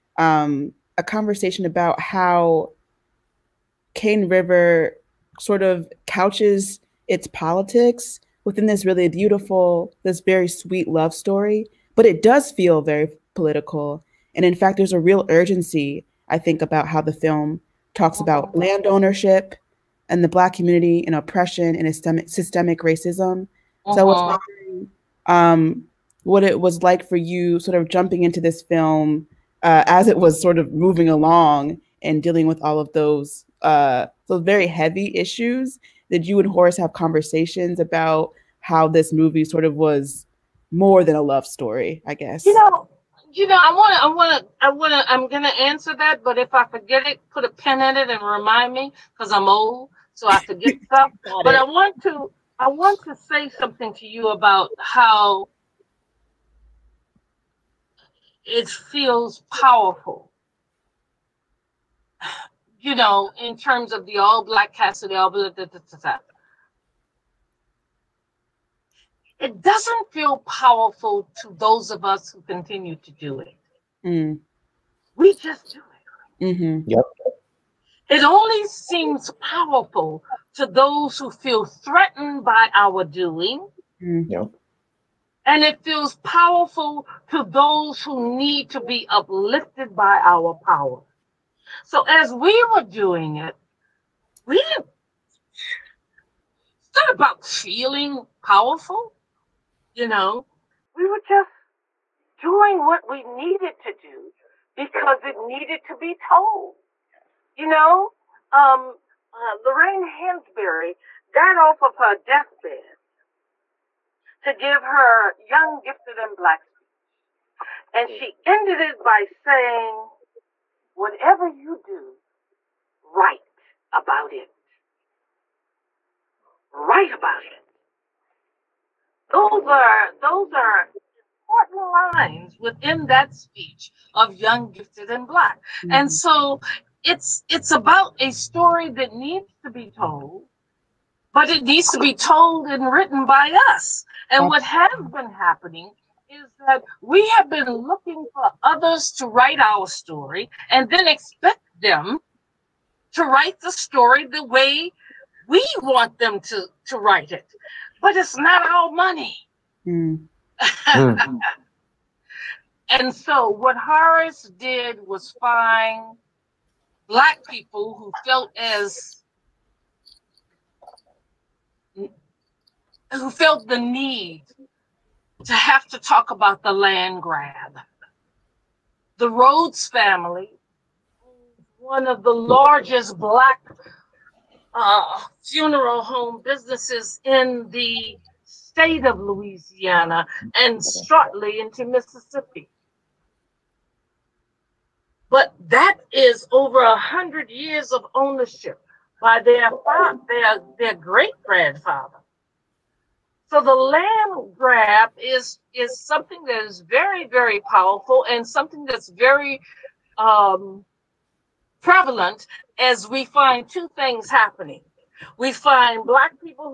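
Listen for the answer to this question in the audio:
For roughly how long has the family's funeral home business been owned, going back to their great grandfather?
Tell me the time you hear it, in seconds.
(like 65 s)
196 s.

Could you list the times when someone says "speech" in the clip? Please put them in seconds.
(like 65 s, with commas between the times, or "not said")
116 s, 133 s.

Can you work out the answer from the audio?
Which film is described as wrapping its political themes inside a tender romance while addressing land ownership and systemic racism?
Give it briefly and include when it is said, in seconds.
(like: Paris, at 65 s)
Cane River, at 3 s.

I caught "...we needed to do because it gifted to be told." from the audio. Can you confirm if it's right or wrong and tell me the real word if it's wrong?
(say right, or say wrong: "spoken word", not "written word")
wrong: "needed", not "gifted".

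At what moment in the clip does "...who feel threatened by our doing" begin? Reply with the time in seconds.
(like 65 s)
81 s.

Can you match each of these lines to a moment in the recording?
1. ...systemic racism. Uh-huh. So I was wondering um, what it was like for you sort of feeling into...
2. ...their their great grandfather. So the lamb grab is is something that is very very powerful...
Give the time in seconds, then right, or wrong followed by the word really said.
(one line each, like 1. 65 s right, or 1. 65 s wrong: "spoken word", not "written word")
1. 22 s wrong: "jumping", not "feeling"
2. 200 s right.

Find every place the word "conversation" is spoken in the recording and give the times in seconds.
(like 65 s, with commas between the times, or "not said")
1 s, 36 s.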